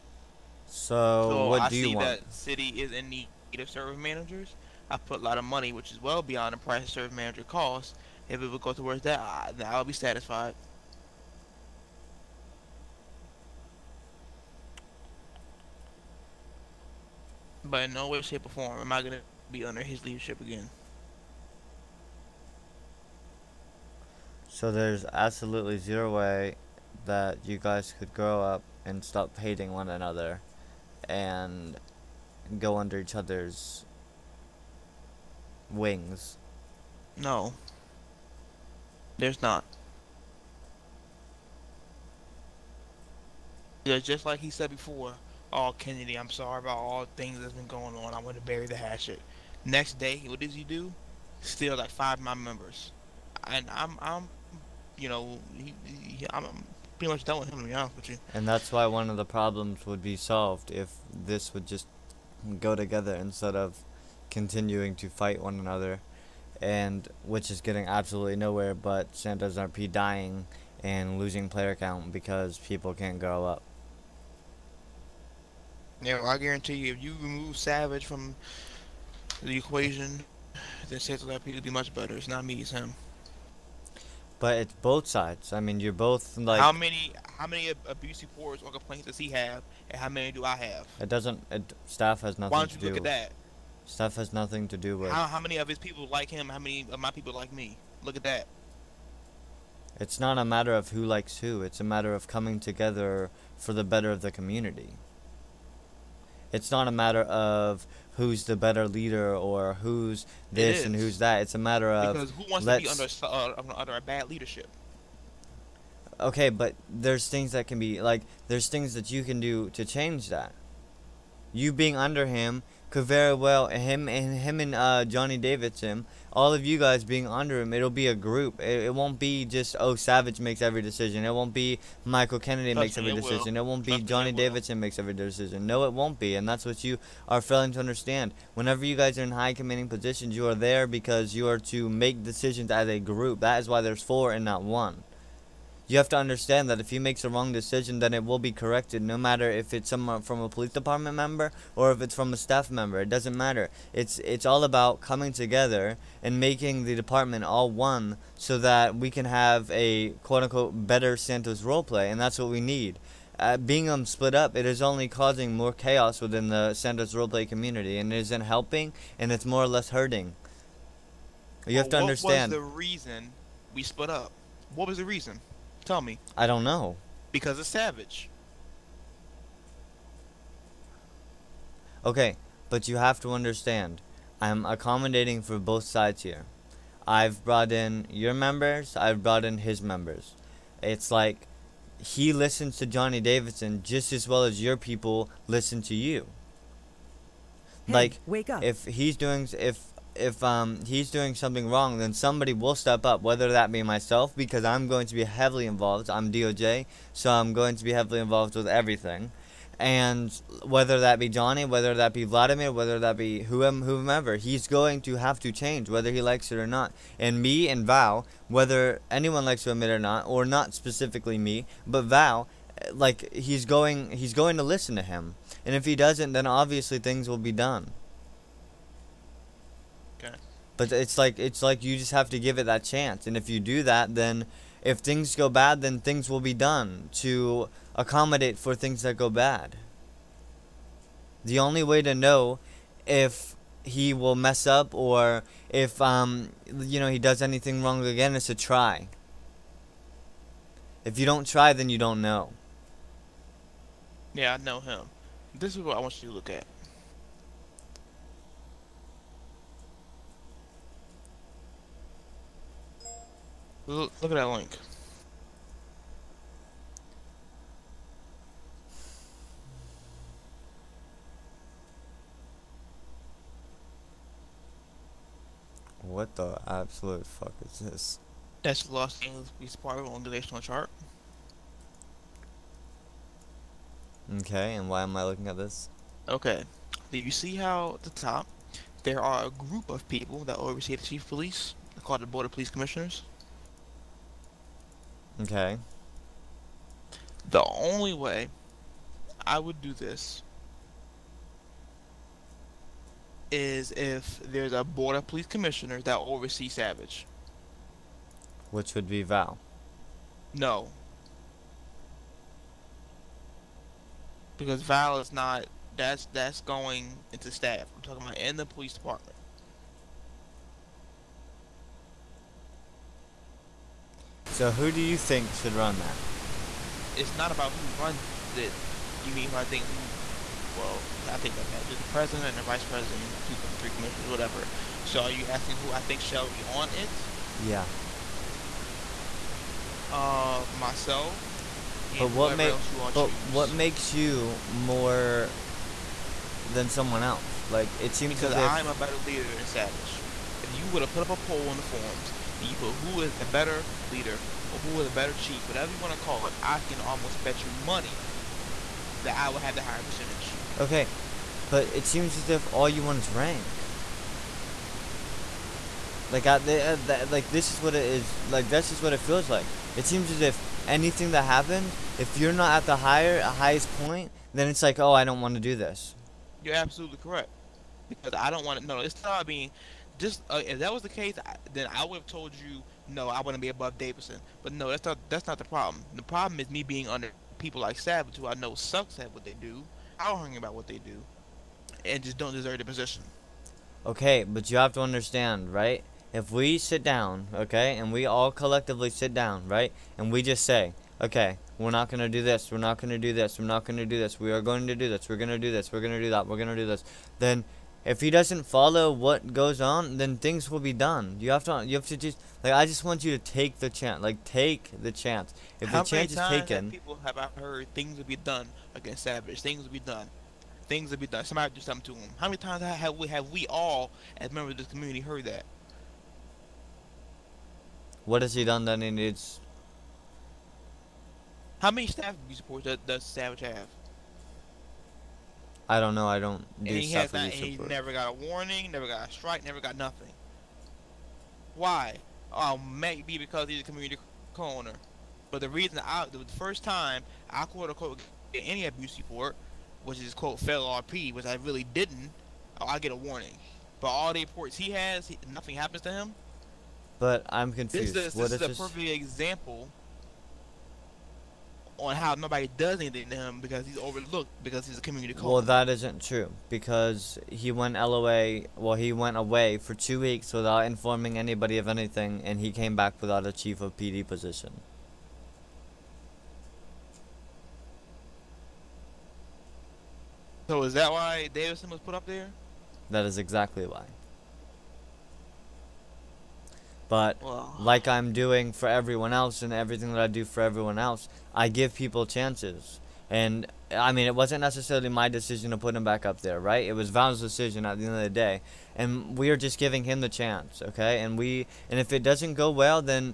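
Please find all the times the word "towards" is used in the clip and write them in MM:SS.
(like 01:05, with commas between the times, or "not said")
00:08.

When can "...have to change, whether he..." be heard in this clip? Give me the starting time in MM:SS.
03:35.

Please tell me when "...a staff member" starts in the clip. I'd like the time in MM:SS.
02:32.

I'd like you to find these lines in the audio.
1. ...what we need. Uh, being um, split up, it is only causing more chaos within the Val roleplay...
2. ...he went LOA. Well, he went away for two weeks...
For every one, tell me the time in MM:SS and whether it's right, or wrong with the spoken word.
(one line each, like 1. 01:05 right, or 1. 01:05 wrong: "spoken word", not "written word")
1. 02:42 wrong: "Santos", not "Val"
2. 07:47 right.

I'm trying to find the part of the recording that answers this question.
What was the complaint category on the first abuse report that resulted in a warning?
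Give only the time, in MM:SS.
07:30.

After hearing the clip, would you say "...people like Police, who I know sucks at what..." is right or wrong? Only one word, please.
wrong.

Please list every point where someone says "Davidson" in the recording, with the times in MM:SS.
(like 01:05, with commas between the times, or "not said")
02:05, 02:14, 03:13, 06:23, 08:01.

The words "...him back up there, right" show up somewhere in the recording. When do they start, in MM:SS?
08:15.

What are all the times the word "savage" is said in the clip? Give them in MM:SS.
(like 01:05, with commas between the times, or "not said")
01:17, 02:09, 02:57, 05:06, 05:49, 06:27, 06:59, 07:13.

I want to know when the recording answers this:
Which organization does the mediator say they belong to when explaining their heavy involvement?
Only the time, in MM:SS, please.
03:26.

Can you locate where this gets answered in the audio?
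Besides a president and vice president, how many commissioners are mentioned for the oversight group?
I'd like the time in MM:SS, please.
05:33.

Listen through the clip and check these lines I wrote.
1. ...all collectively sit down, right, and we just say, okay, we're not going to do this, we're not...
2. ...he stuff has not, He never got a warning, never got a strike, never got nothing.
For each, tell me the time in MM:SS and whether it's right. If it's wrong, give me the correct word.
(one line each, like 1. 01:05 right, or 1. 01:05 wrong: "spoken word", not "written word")
1. 06:38 right
2. 07:17 right.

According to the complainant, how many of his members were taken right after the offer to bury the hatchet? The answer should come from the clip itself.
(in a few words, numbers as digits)
5.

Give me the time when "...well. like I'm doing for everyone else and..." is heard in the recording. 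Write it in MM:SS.
08:07.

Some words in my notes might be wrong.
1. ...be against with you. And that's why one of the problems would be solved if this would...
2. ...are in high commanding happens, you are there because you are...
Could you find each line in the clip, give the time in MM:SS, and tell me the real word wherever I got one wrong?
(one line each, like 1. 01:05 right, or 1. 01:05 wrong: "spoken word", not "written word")
1. 00:57 wrong: "honest", not "against"
2. 02:19 wrong: "positions", not "happens".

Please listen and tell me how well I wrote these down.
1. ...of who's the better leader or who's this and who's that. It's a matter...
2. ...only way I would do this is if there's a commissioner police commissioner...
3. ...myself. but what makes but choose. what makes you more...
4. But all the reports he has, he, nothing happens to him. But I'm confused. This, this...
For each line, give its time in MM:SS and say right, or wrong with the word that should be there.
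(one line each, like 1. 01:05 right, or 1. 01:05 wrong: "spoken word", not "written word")
1. 01:47 right
2. 04:57 wrong: "border", not "commissioner"
3. 05:40 right
4. 07:33 right.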